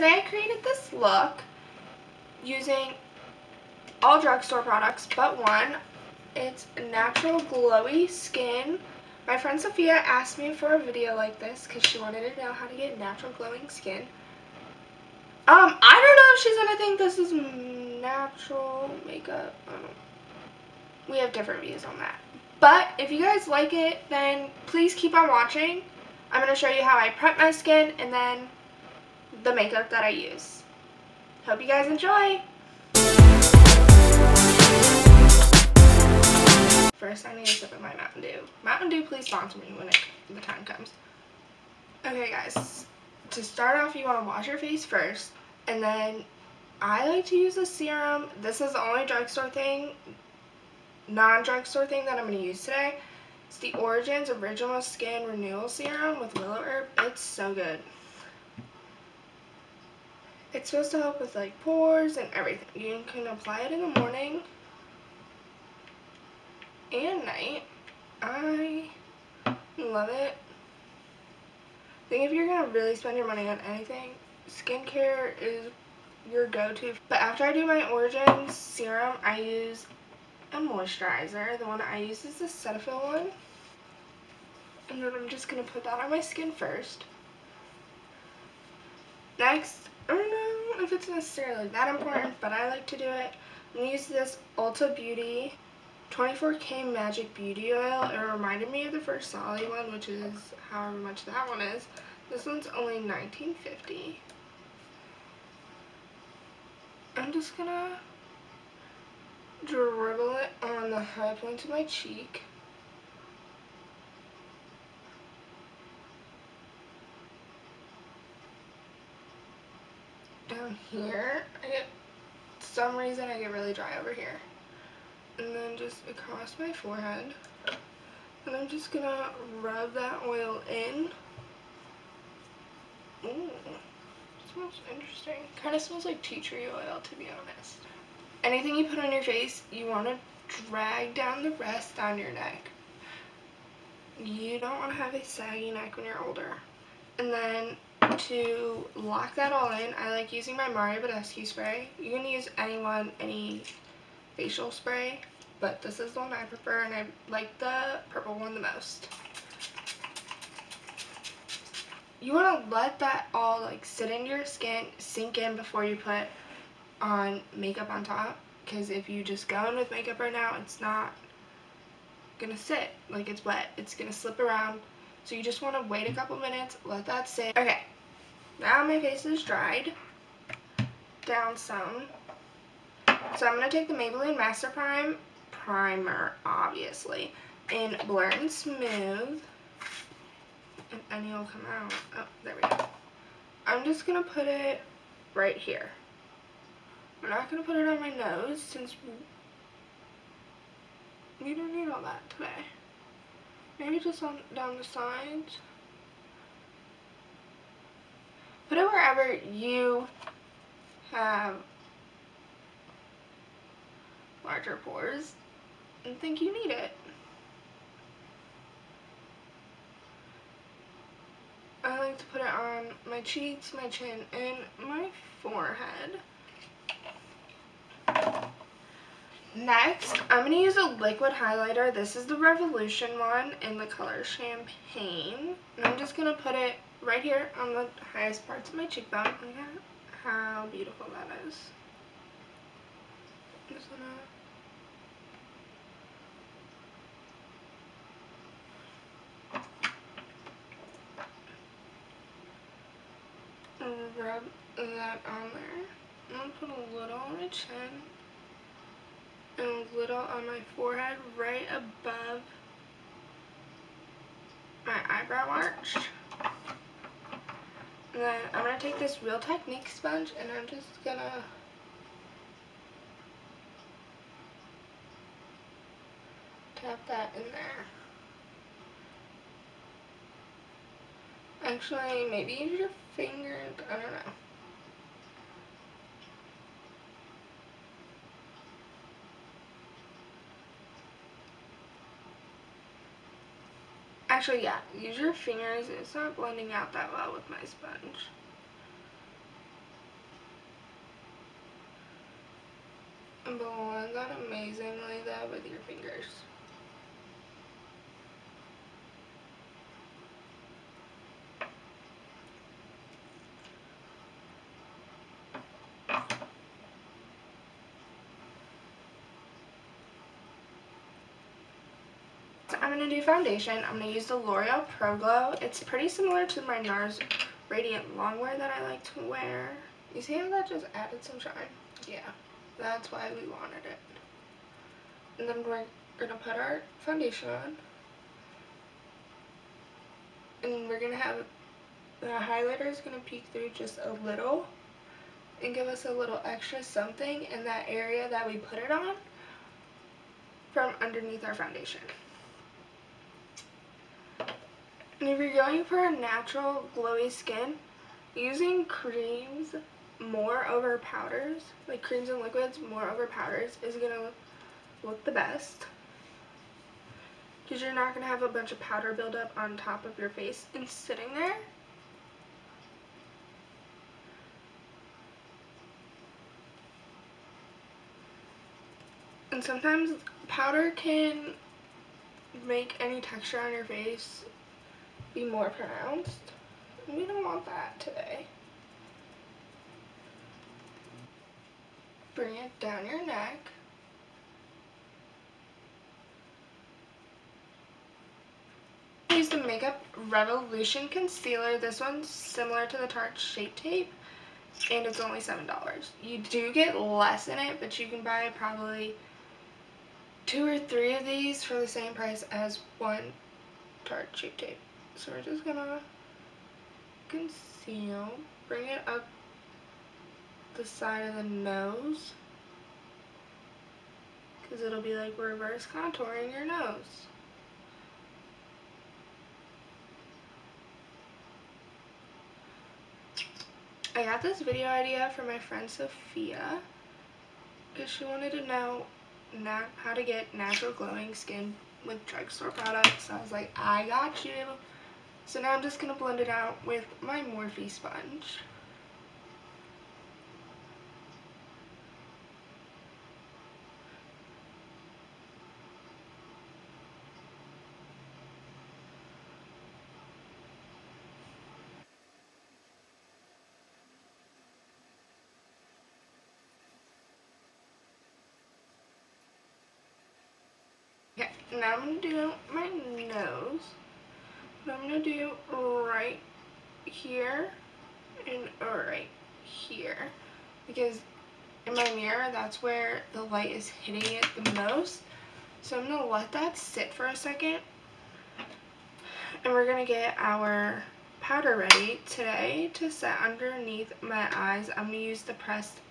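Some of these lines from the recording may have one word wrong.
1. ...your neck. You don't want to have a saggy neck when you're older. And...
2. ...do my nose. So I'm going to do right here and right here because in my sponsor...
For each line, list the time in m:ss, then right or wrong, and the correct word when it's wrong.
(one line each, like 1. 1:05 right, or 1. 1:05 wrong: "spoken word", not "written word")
1. 2:22 right
2. 7:52 wrong: "mirror", not "sponsor".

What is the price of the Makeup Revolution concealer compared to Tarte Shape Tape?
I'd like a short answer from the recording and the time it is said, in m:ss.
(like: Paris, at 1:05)
$7, at 6:45.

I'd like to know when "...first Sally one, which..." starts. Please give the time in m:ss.
1:38.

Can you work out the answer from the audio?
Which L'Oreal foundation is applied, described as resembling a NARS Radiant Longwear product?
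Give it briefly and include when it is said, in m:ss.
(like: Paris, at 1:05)
Pro Glow, at 5:24.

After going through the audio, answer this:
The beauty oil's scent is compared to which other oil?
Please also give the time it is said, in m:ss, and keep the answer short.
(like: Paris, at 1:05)
tea tree oil, at 2:16.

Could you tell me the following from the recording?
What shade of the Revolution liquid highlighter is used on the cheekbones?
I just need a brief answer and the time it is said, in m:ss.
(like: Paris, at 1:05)
Champagne, at 3:54.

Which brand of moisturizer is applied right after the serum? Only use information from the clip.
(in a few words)
Cetaphil.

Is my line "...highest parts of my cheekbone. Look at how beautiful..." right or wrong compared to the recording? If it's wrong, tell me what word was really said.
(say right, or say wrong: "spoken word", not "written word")
right.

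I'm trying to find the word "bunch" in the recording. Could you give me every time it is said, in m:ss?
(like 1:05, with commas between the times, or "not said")
6:08.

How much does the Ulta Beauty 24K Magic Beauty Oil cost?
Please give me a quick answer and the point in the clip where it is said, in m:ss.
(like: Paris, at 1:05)
19.50, at 1:42.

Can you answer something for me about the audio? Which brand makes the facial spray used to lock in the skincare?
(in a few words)
Mario Badescu.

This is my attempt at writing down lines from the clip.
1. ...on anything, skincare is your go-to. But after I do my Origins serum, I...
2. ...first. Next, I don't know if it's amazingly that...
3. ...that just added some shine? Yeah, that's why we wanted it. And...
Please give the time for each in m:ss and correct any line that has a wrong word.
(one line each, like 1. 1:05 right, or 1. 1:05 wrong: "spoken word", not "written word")
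1. 1:13 right
2. 1:26 wrong: "necessarily", not "amazingly"
3. 5:30 right.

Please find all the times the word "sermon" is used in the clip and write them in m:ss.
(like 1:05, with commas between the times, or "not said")
not said.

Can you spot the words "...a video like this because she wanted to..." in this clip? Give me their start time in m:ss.
0:10.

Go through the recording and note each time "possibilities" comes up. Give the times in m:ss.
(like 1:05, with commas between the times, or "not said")
not said.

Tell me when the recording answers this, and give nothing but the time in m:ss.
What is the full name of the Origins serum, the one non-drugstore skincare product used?
0:54.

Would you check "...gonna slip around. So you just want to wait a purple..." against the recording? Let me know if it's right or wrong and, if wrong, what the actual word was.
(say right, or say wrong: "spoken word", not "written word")
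wrong: "couple", not "purple".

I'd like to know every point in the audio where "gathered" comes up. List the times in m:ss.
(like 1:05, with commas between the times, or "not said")
not said.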